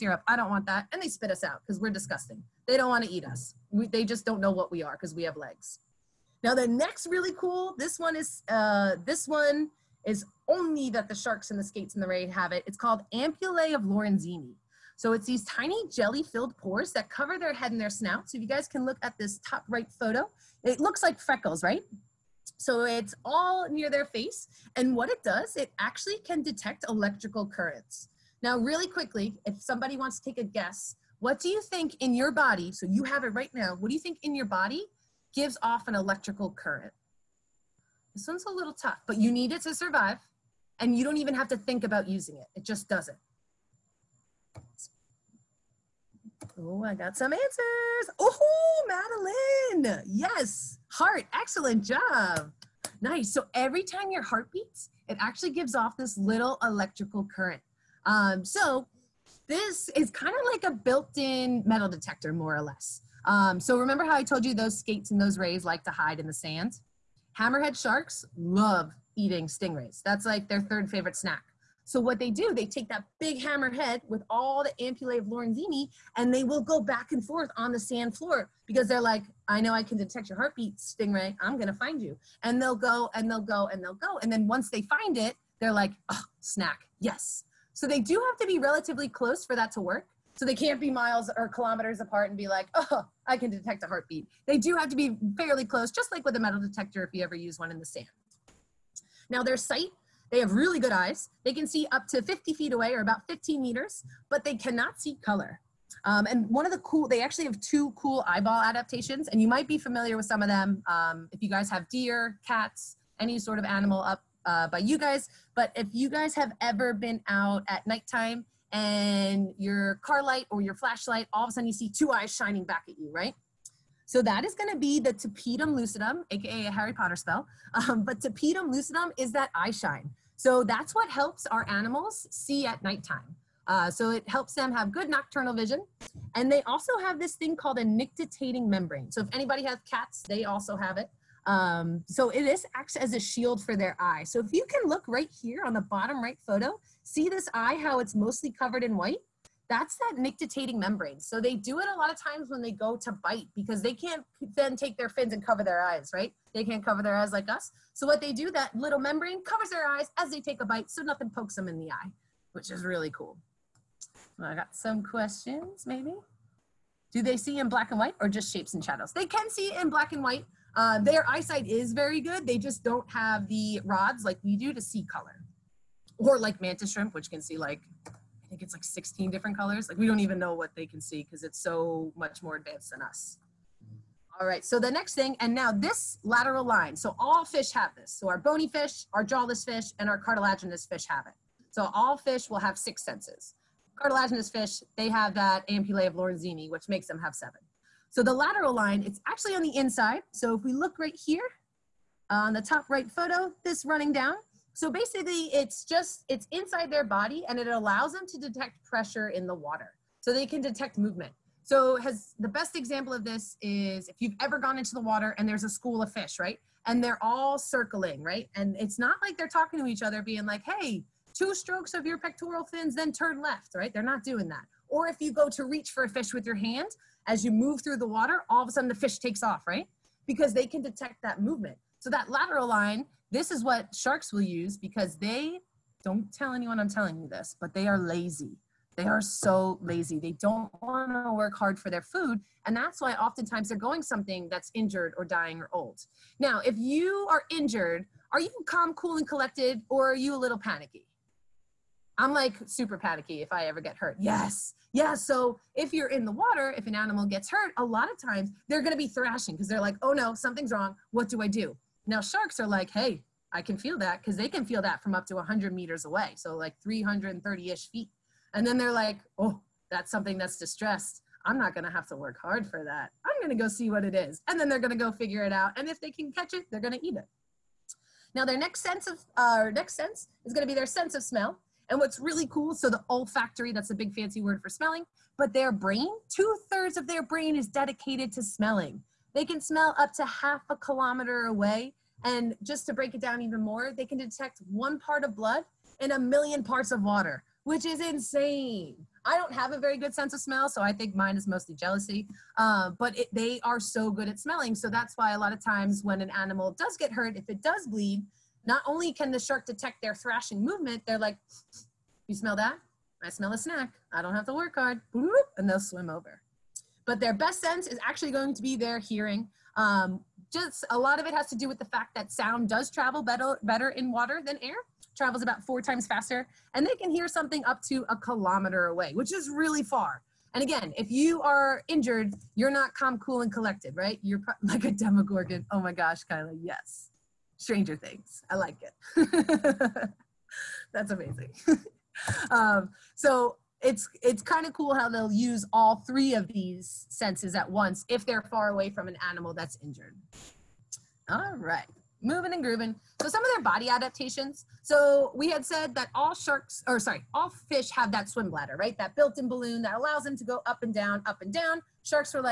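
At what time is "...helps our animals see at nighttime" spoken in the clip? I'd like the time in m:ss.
2:11.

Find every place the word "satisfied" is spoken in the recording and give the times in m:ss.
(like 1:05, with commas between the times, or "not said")
not said.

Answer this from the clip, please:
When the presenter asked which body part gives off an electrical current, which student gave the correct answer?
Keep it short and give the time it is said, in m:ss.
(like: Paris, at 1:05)
Madeline, at 0:49.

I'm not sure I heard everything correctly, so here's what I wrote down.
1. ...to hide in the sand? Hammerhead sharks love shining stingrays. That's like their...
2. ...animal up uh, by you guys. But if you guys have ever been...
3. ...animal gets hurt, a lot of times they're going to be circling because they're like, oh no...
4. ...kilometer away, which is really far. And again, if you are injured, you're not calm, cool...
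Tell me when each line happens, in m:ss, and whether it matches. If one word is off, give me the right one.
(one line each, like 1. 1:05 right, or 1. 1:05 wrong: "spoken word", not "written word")
1. 1:05 wrong: "eating", not "shining"
2. 1:53 right
3. 4:16 wrong: "thrashing", not "circling"
4. 5:28 right.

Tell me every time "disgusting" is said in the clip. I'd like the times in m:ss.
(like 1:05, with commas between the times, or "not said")
0:01.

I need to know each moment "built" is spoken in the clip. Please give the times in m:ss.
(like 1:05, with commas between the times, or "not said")
1:00, 5:59.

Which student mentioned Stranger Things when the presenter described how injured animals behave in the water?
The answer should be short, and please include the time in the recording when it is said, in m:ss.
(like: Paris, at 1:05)
Kyla, at 5:36.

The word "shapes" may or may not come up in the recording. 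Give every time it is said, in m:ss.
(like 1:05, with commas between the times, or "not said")
2:48.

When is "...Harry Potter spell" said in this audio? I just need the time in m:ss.
2:06.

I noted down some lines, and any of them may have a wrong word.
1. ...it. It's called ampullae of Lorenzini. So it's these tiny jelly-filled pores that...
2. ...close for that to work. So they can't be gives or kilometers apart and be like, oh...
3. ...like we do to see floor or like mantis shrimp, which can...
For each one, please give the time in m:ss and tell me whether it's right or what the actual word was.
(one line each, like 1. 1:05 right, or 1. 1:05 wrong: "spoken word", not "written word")
1. 0:12 right
2. 1:29 wrong: "miles", not "gives"
3. 2:54 wrong: "color", not "floor".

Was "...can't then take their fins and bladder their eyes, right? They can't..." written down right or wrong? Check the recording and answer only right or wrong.
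wrong.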